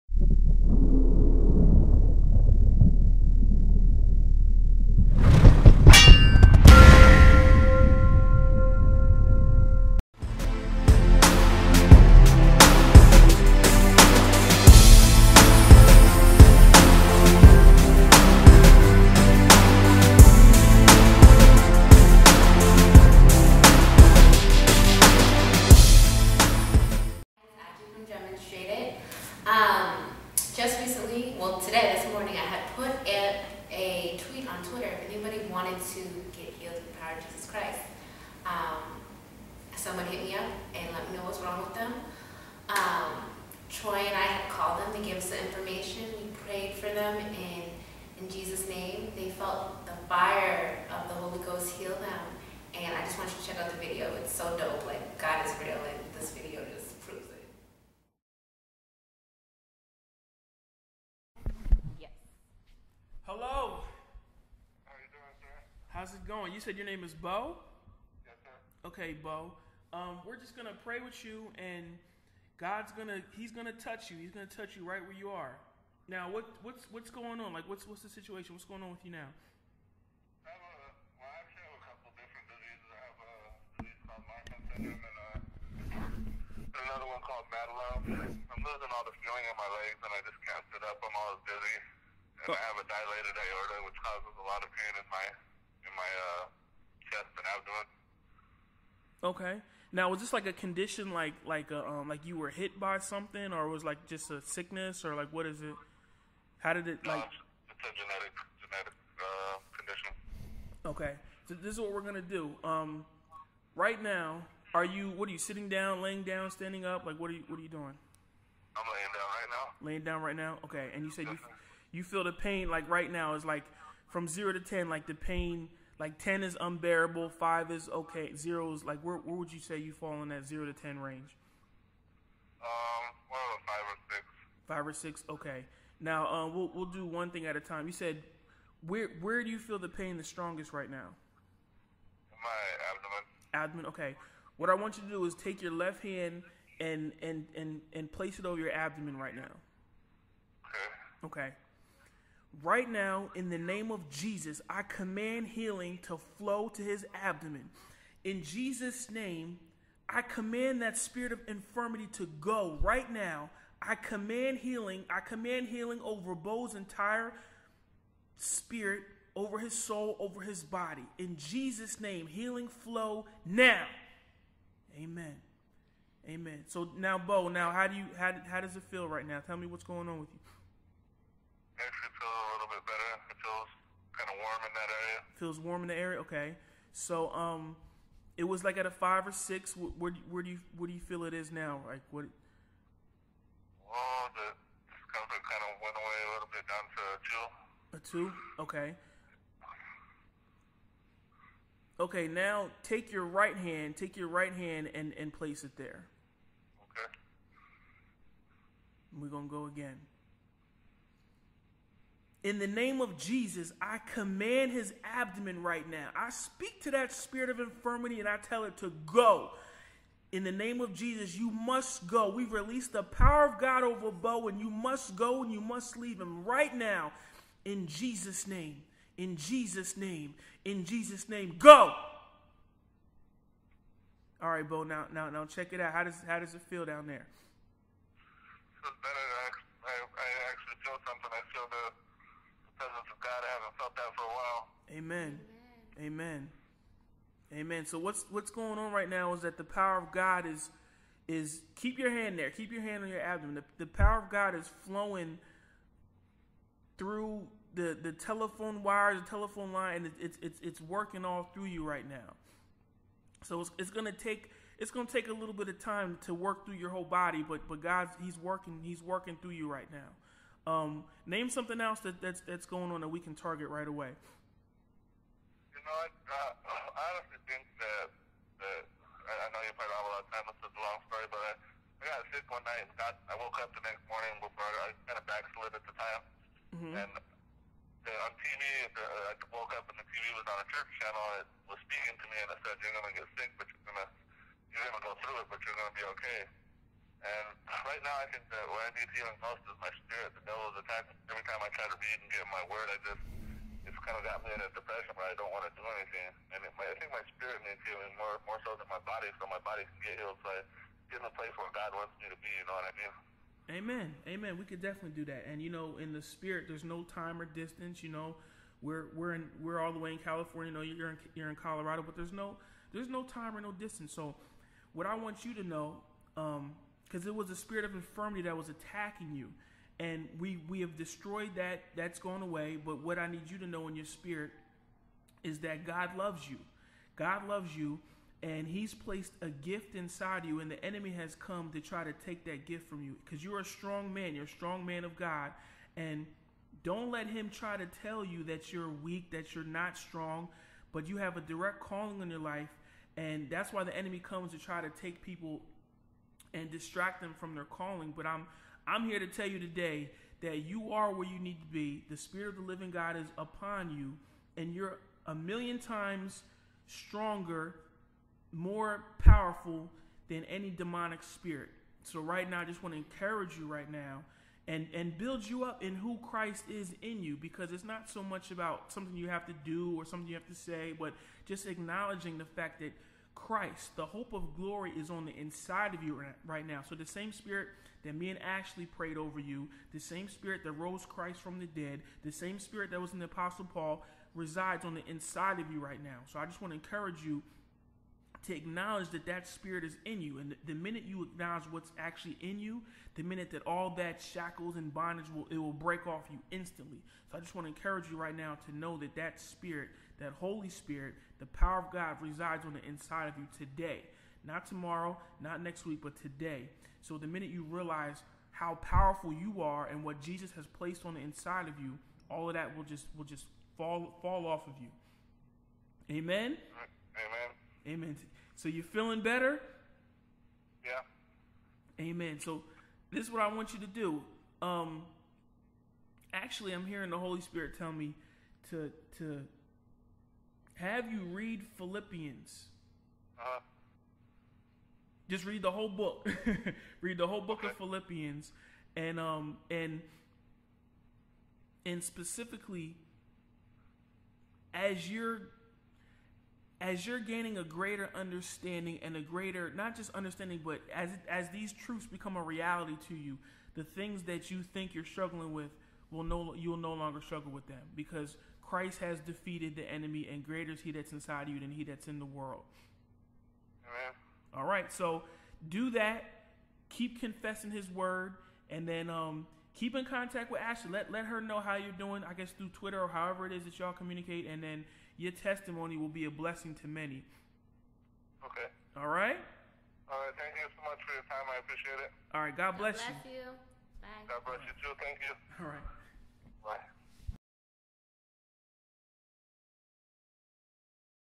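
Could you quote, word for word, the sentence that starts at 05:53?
And that's why the enemy comes to try to take people and distract them from their calling.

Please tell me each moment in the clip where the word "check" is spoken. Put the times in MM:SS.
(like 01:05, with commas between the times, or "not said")
00:53, 03:55.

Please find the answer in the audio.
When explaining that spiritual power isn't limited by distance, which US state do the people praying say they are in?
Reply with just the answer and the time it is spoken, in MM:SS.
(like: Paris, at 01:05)
California, at 05:20.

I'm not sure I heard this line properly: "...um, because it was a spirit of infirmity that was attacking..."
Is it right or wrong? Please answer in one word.
right.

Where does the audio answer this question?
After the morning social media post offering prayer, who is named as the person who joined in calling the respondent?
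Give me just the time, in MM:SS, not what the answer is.
00:43.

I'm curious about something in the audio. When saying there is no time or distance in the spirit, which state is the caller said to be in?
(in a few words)
Colorado.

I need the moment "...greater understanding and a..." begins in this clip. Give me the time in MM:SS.
07:37.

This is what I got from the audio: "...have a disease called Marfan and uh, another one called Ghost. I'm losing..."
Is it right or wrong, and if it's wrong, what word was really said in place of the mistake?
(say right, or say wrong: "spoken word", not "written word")
wrong: "Madelung", not "Ghost".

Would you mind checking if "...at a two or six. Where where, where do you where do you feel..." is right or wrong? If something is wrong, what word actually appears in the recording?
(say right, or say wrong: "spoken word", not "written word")
wrong: "five", not "two".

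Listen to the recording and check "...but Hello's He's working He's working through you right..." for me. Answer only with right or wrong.
wrong.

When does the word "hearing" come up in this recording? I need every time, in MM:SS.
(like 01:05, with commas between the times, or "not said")
07:16.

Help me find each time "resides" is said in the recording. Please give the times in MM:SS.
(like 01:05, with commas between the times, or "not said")
06:34, 06:52.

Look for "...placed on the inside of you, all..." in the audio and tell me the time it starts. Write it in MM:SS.
07:00.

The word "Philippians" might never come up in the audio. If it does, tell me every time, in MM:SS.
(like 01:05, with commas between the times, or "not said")
07:21, 07:27.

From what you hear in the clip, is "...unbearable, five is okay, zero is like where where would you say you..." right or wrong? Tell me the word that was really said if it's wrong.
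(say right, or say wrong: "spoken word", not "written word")
right.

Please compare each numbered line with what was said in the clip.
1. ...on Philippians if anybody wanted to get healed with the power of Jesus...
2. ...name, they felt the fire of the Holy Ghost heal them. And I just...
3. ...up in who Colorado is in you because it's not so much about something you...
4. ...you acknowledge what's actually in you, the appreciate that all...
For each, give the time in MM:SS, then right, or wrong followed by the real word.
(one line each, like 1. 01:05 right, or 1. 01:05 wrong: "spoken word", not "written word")
1. 00:34 wrong: "Twitter", not "Philippians"
2. 00:48 right
3. 06:15 wrong: "Christ", not "Colorado"
4. 06:41 wrong: "minute", not "appreciate".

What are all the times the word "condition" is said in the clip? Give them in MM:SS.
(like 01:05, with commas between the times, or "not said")
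01:40, 01:49.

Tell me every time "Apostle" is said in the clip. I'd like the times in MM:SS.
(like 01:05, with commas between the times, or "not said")
06:33.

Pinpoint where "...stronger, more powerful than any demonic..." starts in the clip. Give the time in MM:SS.
06:06.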